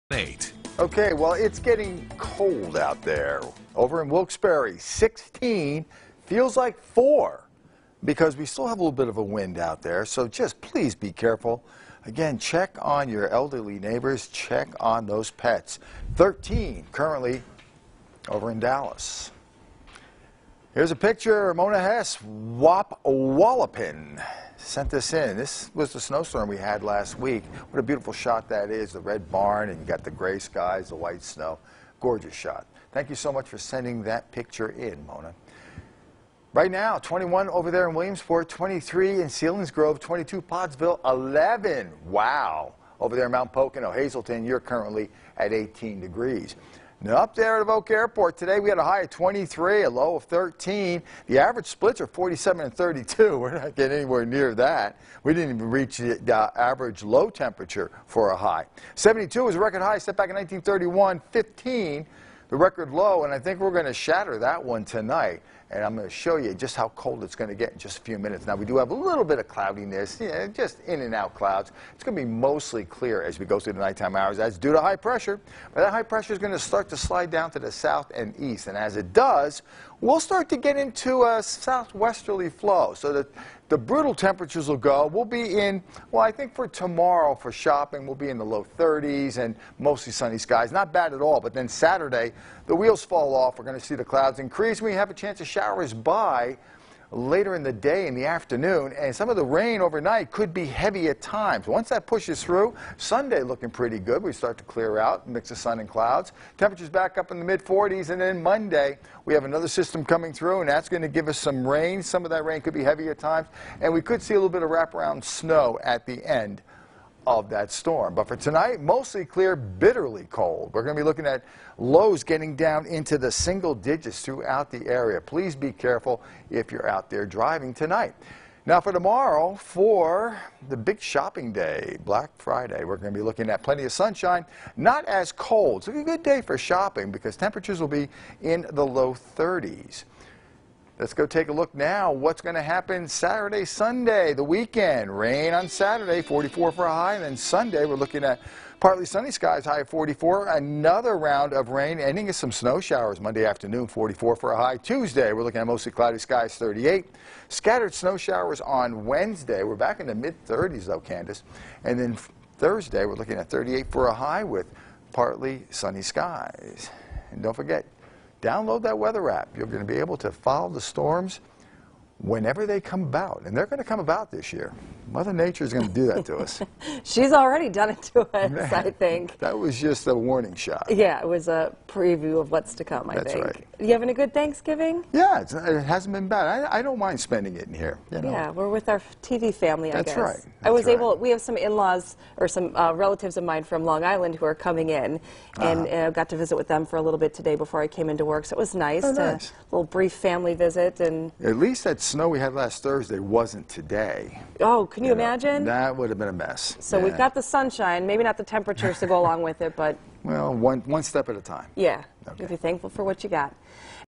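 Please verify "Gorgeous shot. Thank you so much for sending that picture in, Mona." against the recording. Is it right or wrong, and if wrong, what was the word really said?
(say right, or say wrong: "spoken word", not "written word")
right.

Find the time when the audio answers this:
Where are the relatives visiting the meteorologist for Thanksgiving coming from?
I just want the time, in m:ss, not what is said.
3:13.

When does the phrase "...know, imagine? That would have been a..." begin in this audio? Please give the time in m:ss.
3:25.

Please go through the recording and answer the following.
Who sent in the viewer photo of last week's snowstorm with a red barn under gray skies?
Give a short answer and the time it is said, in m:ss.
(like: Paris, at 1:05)
Mona Hess, at 0:21.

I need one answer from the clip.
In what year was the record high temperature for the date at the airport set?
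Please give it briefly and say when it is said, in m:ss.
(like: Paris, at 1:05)
1931, at 1:00.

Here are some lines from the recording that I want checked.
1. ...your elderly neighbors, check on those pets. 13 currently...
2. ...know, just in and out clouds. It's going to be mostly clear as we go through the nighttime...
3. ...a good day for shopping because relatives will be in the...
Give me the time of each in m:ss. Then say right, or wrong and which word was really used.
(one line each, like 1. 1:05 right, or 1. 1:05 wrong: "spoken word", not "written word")
1. 0:13 right
2. 1:10 right
3. 2:15 wrong: "temperatures", not "relatives".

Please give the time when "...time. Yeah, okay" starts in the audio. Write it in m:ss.
3:31.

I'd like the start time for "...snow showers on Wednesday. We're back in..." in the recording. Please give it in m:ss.
2:37.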